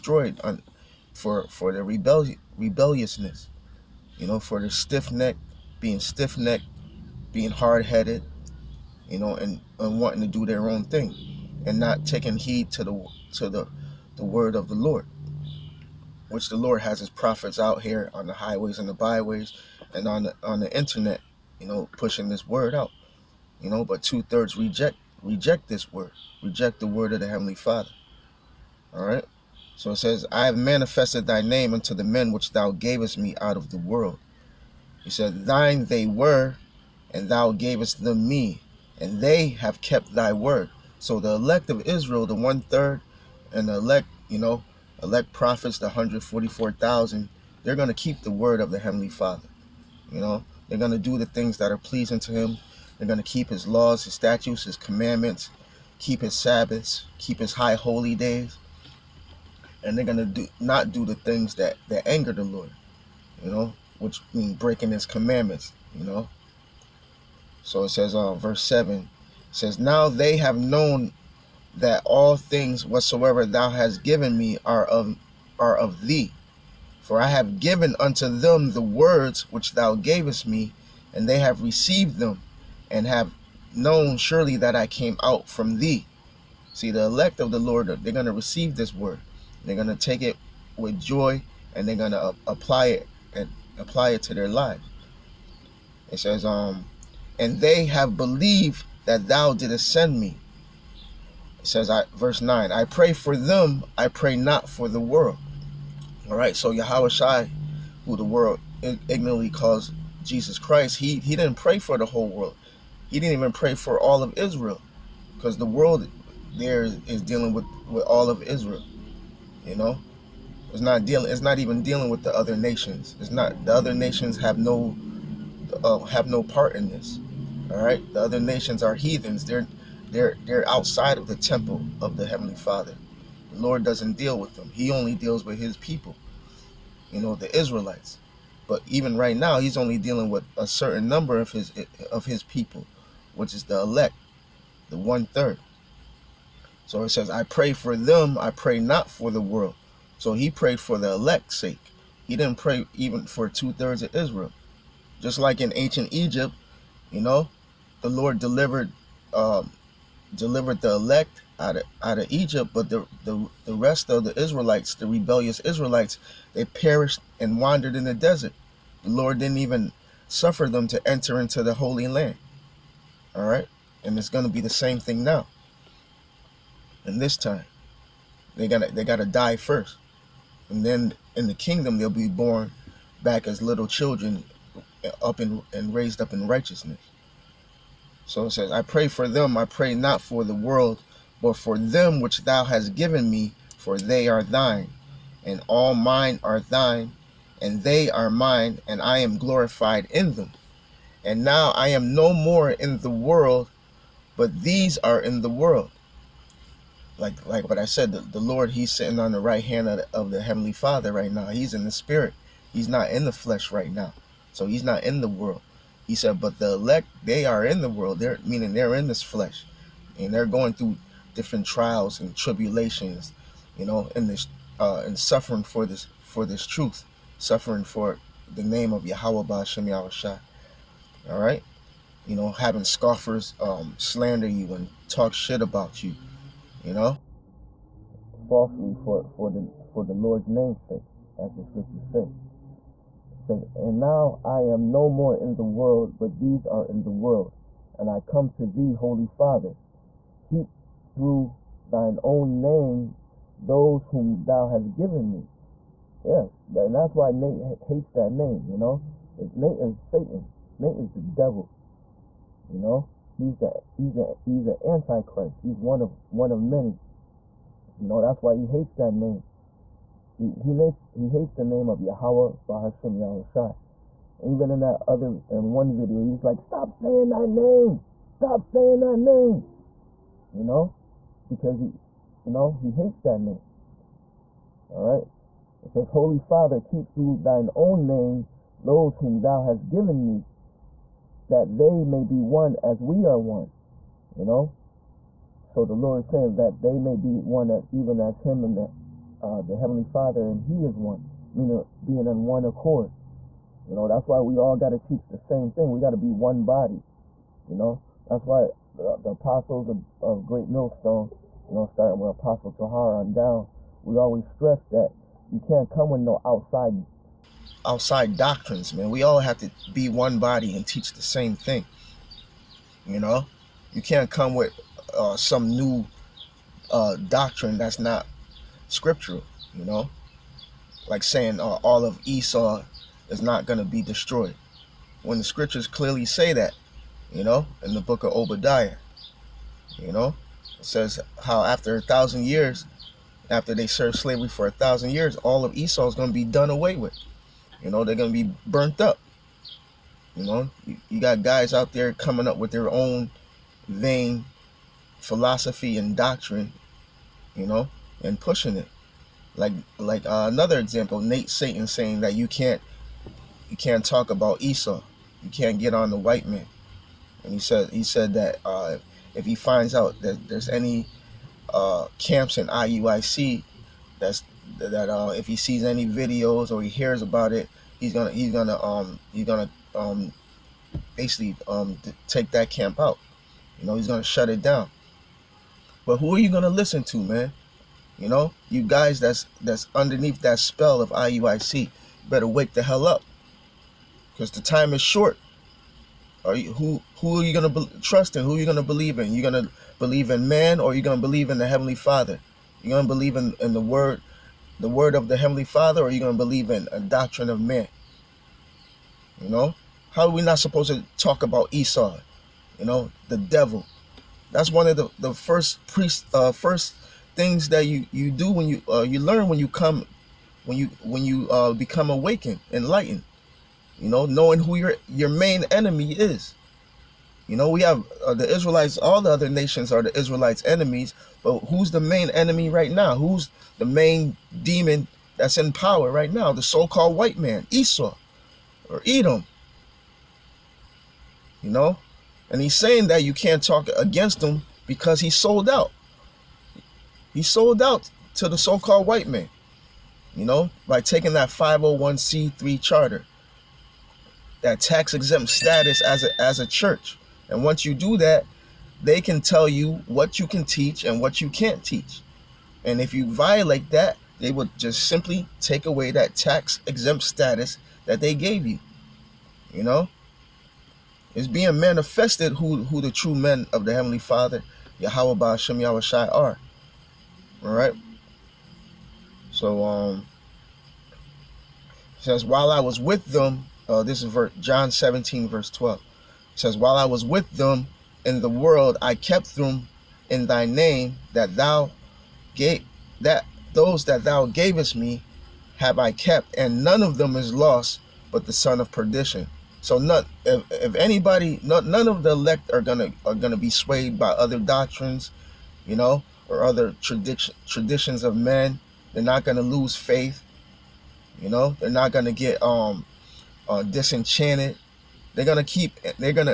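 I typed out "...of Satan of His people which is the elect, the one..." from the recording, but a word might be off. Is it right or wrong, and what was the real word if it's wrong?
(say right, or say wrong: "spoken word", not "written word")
wrong: "His", not "Satan".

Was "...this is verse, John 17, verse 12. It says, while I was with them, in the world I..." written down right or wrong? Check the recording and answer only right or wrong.
right.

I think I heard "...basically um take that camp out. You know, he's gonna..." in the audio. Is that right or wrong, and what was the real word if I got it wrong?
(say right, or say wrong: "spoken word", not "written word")
right.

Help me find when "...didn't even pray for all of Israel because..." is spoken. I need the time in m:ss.
1:53.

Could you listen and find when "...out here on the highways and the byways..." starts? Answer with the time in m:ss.
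0:17.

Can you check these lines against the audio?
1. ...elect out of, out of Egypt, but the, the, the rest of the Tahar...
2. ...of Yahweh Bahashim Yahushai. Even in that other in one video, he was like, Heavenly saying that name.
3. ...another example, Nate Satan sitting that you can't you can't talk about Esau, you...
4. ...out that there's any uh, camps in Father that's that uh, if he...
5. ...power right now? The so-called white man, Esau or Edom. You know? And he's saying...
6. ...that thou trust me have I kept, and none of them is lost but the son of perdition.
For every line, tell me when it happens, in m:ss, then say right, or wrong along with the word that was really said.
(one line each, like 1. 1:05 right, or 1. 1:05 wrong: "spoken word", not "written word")
1. 2:40 wrong: "Israelites", not "Tahar"
2. 4:31 wrong: "Stop", not "Heavenly"
3. 6:00 wrong: "saying", not "sitting"
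4. 6:09 wrong: "IUIC", not "Father"
5. 7:15 right
6. 8:14 wrong: "gavest", not "trust".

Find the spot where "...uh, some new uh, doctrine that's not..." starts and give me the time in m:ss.
5:25.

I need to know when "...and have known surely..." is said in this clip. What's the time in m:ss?
1:22.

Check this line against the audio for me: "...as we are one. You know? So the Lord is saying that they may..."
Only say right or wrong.
right.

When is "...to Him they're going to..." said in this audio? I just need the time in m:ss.
0:52.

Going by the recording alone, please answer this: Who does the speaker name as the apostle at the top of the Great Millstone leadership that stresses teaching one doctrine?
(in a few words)
Apostle Tahar.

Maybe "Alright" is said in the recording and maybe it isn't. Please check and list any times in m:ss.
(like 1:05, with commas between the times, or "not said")
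4:44, 7:57.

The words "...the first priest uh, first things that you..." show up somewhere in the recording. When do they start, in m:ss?
6:55.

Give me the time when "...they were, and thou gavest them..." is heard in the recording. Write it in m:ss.
0:35.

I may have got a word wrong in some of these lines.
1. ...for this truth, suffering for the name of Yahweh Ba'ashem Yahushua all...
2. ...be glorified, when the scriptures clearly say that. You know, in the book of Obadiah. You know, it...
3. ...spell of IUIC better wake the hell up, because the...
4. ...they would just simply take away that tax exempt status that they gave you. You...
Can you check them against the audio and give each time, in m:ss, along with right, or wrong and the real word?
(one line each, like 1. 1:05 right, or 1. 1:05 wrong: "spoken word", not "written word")
1. 3:46 right
2. 5:33 wrong: "destroyed", not "glorified"
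3. 6:30 right
4. 7:44 right.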